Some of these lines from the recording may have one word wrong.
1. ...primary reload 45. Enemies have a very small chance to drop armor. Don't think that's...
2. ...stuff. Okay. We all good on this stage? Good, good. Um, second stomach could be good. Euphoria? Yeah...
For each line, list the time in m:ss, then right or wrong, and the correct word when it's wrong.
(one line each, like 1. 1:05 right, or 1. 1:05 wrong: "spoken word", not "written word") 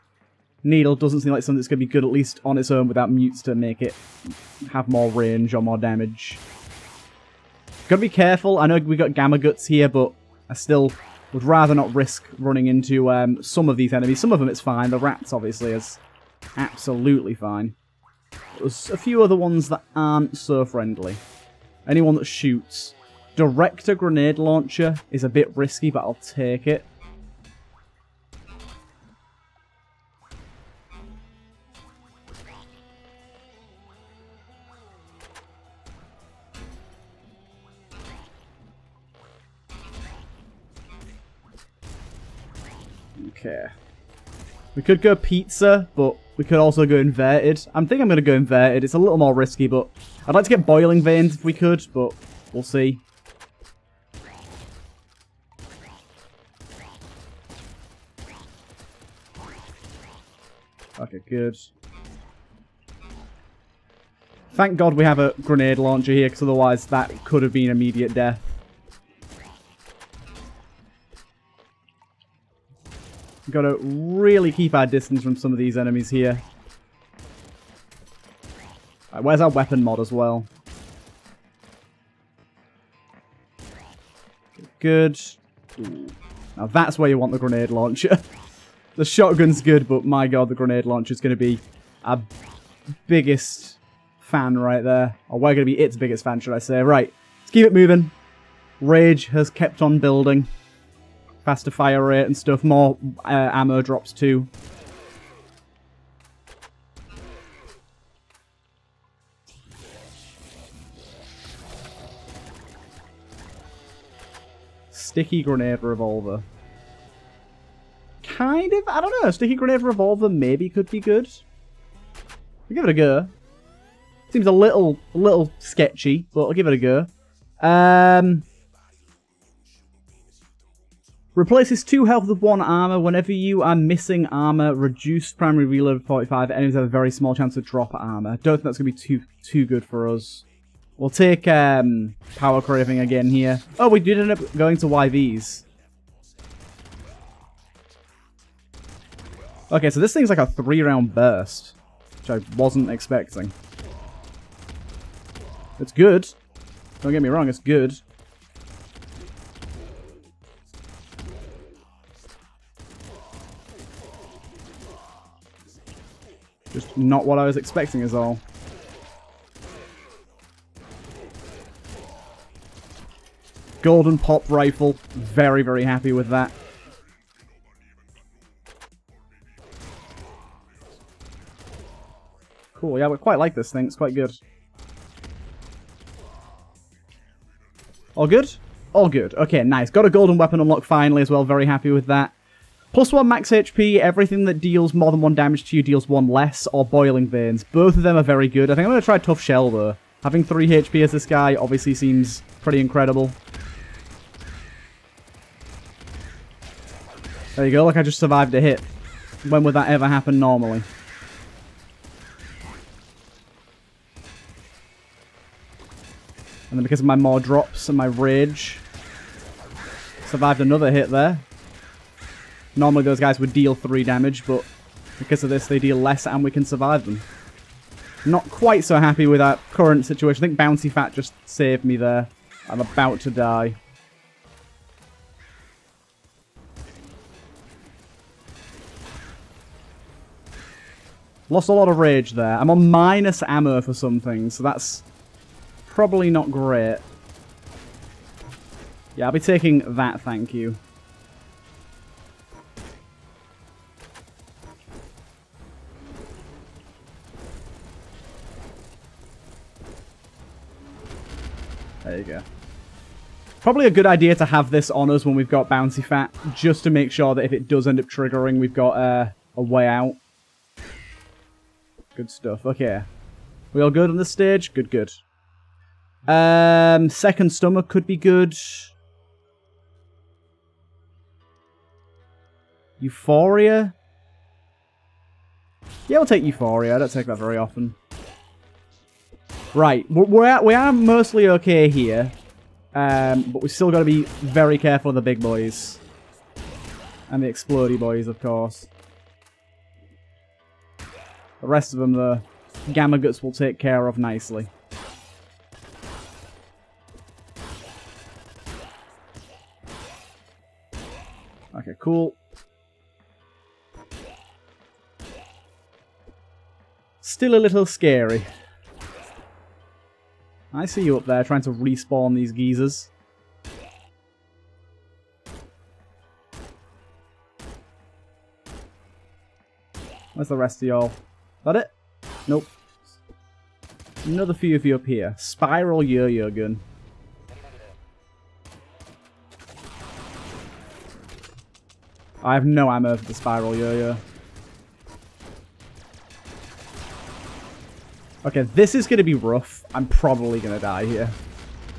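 1. 2:15 right
2. 4:32 right.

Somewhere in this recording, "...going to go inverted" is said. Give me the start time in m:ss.
0:48.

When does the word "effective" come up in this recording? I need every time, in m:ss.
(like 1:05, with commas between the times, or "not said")
not said.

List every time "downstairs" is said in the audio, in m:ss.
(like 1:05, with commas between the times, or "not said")
not said.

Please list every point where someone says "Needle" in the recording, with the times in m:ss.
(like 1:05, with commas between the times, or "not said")
0:00.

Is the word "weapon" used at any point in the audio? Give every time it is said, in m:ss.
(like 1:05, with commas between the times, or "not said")
1:19, 3:10.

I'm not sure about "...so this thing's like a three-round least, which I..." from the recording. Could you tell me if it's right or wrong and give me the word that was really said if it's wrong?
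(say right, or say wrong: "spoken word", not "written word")
wrong: "burst", not "least".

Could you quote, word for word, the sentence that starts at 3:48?
Not quite so happy with our current situation.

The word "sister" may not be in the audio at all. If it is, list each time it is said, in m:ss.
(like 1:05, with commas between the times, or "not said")
not said.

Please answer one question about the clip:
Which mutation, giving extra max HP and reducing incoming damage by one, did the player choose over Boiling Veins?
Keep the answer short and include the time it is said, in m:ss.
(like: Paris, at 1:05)
Tough Shell, at 3:19.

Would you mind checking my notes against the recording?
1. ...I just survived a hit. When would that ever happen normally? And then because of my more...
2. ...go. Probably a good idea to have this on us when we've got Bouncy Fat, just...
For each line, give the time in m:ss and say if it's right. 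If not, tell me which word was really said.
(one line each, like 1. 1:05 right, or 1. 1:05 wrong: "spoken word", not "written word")
1. 3:27 right
2. 4:22 right.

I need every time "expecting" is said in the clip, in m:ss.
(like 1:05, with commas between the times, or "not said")
2:32, 2:47.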